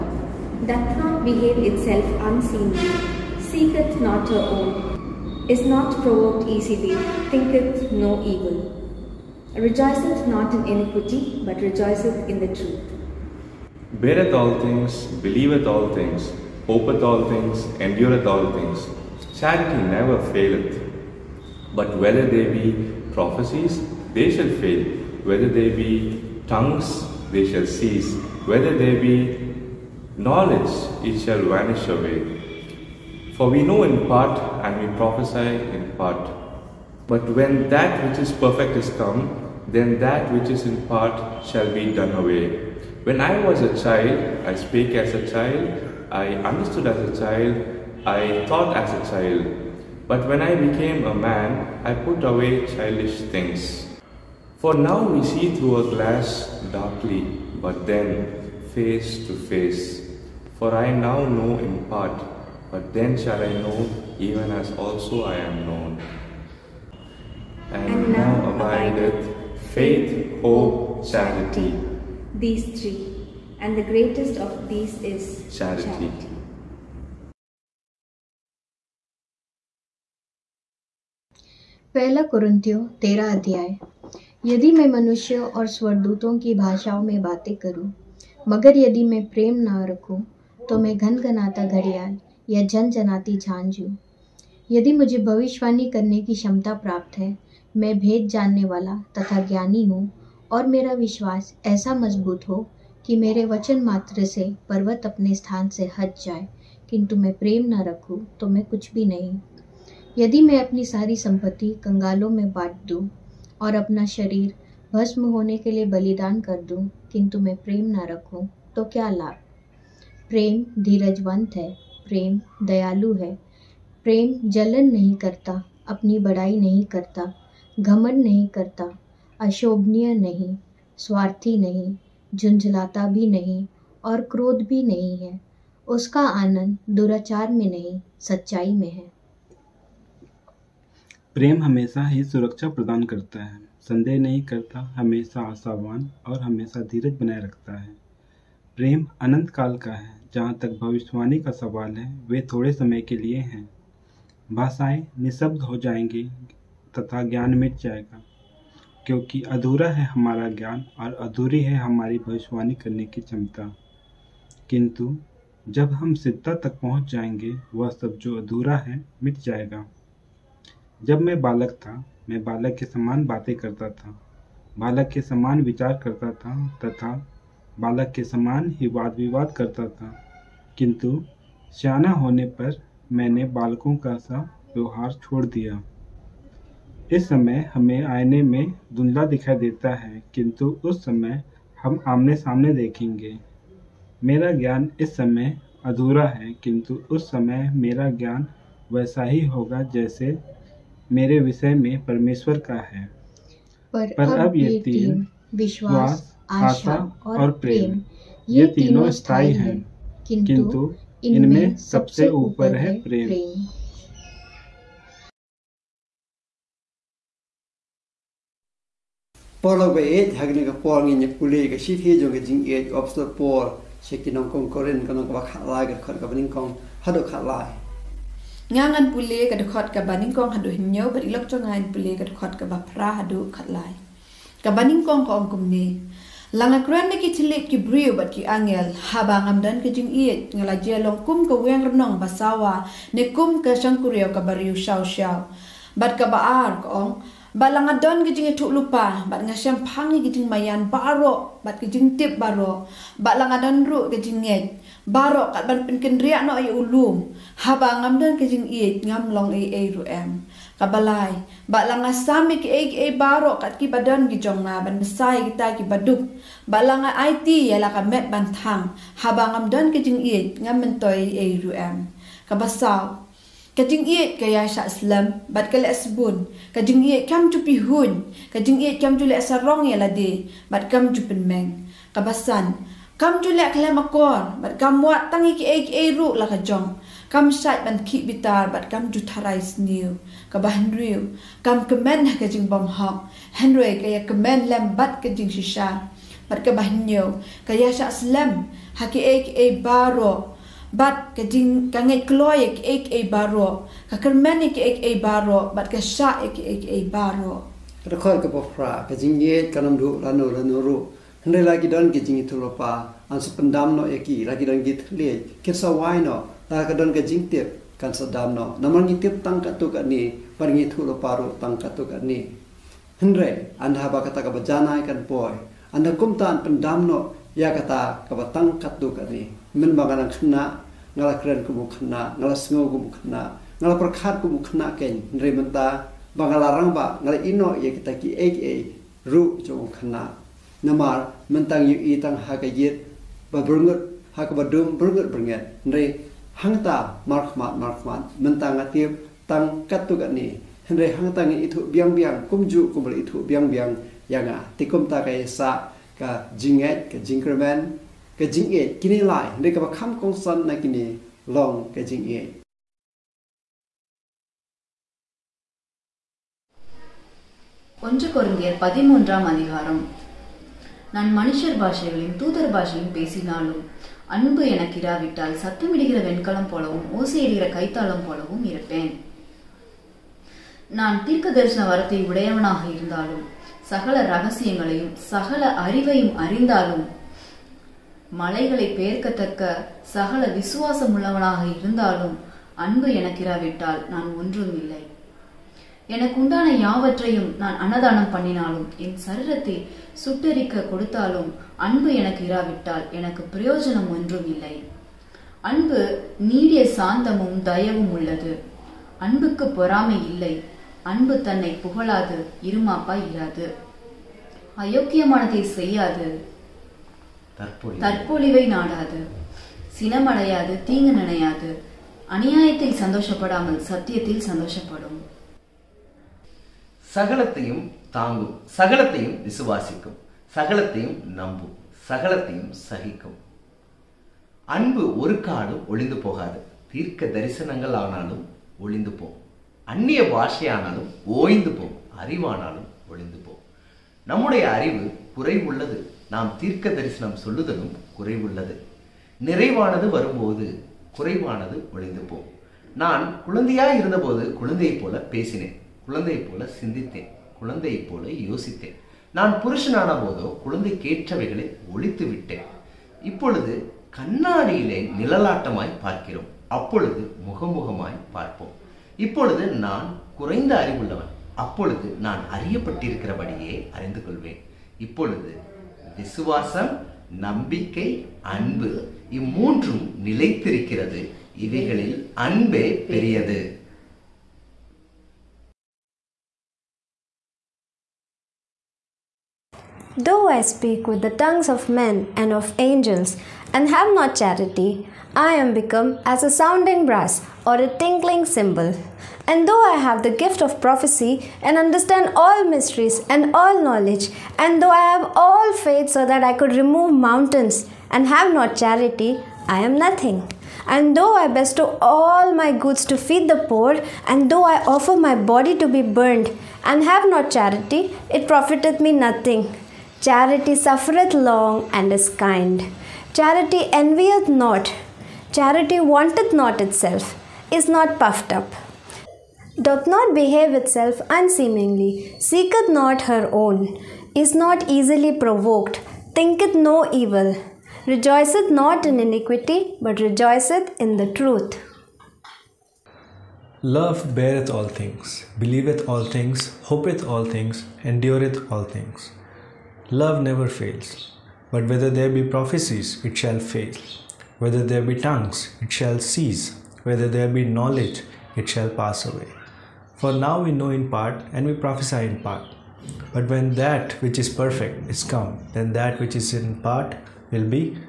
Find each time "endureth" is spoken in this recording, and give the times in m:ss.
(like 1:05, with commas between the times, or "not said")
0:17, 9:08.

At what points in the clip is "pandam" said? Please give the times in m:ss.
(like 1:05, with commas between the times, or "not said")
5:13, 5:26.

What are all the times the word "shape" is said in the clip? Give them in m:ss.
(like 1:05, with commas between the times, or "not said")
not said.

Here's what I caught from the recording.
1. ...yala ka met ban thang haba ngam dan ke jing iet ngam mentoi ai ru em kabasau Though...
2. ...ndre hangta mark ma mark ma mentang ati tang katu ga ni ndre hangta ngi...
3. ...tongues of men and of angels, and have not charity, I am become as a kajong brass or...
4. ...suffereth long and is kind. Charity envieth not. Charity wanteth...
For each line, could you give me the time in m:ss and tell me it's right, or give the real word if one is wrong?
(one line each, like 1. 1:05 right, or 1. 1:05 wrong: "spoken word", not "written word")
1. 4:27 wrong: "Kajing", not "Though"
2. 5:45 right
3. 8:11 wrong: "sounding", not "kajong"
4. 8:40 right.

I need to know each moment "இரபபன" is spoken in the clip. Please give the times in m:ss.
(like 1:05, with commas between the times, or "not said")
6:18.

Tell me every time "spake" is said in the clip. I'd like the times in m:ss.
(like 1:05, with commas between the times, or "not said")
0:44.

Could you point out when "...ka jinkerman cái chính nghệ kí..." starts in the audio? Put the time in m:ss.
5:57.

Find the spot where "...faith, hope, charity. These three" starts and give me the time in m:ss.
1:09.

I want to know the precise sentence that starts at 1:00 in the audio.
For I now know in part, but then shall I know even as also I am known.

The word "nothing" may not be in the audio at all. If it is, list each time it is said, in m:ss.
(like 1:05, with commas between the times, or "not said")
8:29, 8:39.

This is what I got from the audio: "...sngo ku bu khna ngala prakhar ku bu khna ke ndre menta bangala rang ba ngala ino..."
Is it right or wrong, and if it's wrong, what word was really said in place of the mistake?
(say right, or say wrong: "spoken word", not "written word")
right.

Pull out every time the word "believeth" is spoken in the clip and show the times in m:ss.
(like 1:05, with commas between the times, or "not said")
0:15, 9:05.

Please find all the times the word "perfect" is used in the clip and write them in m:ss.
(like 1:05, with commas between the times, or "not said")
0:38, 9:24.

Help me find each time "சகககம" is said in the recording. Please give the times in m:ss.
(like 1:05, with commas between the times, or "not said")
7:12.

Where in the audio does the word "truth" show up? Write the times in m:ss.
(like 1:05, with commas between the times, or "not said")
0:12, 9:01.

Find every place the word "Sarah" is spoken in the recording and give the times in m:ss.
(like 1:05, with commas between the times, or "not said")
not said.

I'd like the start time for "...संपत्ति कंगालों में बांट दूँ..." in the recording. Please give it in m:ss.
1:51.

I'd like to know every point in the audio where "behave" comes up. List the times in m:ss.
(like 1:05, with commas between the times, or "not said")
0:01, 8:50.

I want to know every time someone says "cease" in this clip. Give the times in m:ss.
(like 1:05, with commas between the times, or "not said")
0:27, 9:16.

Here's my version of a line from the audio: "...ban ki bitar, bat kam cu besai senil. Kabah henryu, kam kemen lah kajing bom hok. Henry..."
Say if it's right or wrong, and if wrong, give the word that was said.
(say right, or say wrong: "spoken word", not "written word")
wrong: "tarai", not "besai".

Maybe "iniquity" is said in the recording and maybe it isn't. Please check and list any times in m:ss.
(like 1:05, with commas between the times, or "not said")
0:10, 8:59.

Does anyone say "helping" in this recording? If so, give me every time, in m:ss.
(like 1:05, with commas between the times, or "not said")
not said.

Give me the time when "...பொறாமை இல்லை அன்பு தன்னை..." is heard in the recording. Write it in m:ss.
6:49.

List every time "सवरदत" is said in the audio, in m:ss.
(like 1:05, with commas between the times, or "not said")
1:25.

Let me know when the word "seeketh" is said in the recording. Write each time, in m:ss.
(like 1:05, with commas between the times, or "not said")
0:03, 8:52.